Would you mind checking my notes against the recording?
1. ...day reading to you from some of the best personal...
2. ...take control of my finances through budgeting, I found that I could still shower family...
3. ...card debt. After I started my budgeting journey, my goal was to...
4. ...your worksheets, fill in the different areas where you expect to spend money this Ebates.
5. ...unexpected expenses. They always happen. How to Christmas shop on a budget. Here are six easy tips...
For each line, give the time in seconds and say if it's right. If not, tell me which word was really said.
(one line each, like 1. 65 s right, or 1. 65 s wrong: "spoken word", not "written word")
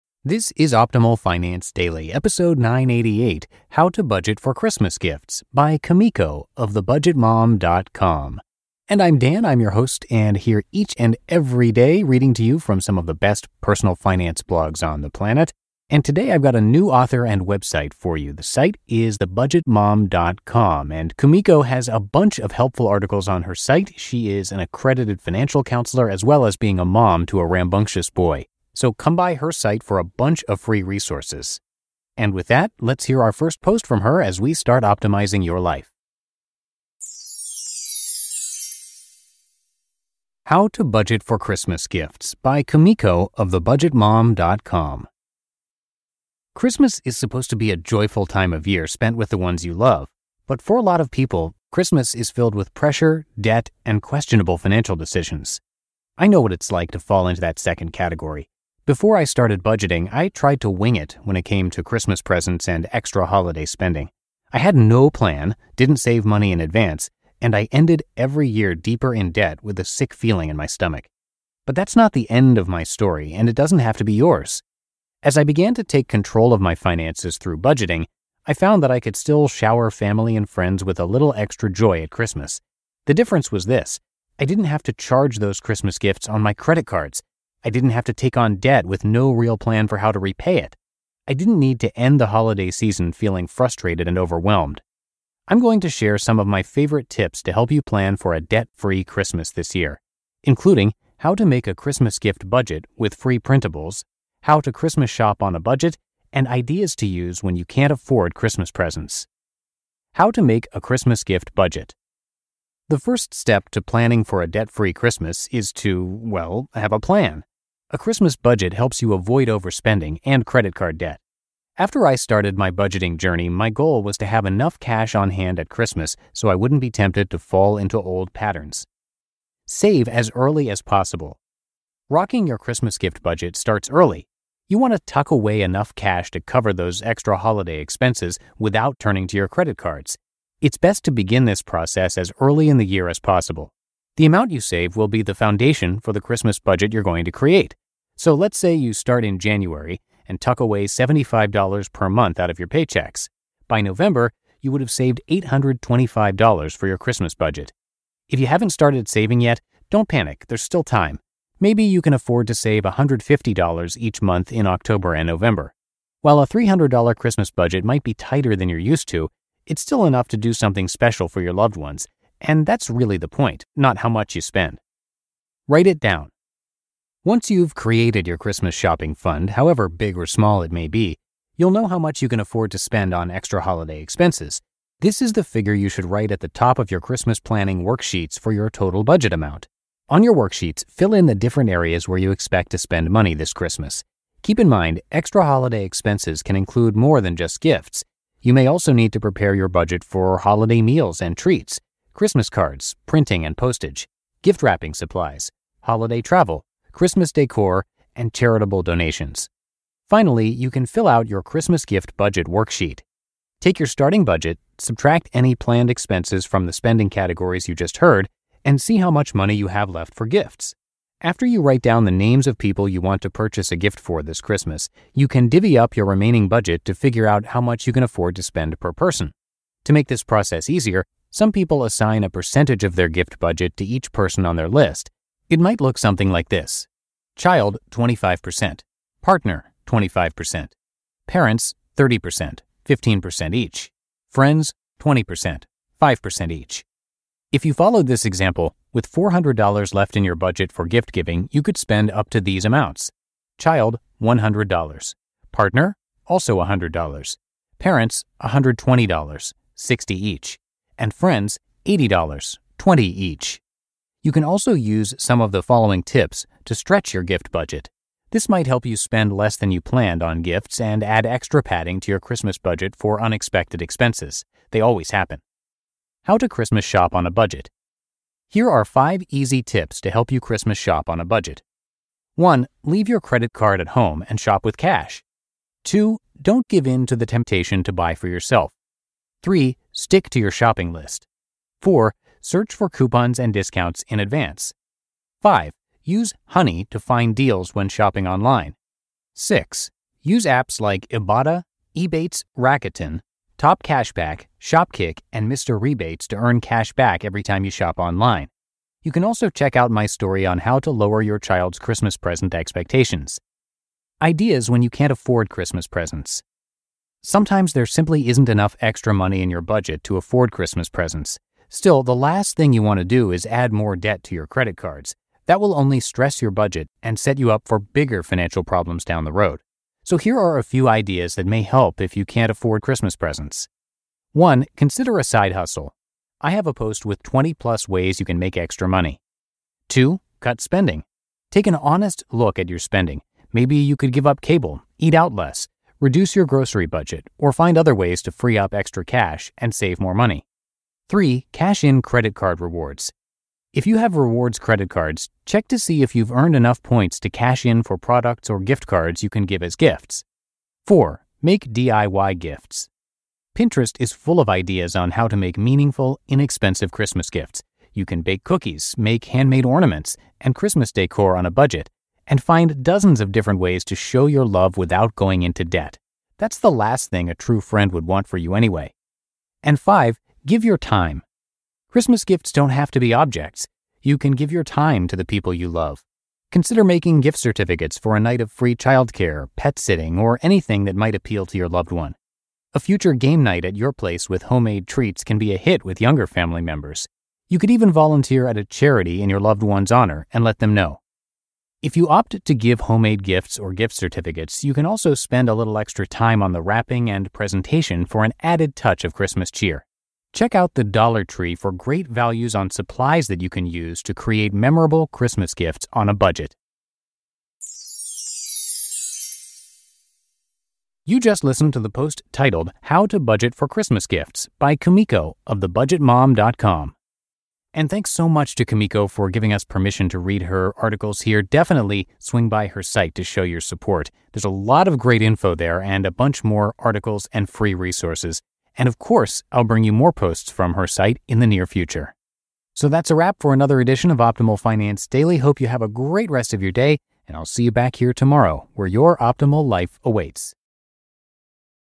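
1. 11 s right
2. 75 s right
3. 120 s right
4. 190 s wrong: "Christmas", not "Ebates"
5. 273 s wrong: "five", not "six".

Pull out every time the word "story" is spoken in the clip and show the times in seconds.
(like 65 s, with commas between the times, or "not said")
72 s, 310 s.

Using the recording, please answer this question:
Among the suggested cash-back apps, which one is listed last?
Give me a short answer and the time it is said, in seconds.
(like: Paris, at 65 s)
Mr. Rebates, at 305 s.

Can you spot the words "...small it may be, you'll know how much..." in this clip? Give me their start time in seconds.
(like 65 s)
180 s.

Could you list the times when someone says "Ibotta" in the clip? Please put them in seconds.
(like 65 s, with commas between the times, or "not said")
301 s.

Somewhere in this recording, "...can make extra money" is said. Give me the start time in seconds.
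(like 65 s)
338 s.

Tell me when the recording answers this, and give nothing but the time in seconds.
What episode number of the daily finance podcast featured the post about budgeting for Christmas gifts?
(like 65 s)
2 s.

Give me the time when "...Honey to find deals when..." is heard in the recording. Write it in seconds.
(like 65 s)
296 s.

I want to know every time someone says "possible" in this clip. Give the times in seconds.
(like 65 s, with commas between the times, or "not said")
130 s, 143 s.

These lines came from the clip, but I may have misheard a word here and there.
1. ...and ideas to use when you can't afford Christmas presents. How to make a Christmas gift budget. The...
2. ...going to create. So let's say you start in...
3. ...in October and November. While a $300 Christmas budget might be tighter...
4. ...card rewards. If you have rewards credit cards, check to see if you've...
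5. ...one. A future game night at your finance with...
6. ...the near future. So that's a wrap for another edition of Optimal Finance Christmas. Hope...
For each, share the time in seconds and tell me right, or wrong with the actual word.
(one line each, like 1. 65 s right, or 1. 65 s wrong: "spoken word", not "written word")
1. 106 s right
2. 147 s right
3. 164 s right
4. 352 s right
5. 391 s wrong: "place", not "finance"
6. 441 s wrong: "Daily", not "Christmas".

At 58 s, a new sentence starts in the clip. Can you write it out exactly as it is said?
Before I started budgeting, I tried to wing it when it came to Christmas presents and extra holiday spending.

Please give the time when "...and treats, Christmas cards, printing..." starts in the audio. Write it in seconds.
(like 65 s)
201 s.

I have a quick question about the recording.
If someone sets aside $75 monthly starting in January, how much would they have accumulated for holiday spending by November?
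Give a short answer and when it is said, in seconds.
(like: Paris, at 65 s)
$825, at 155 s.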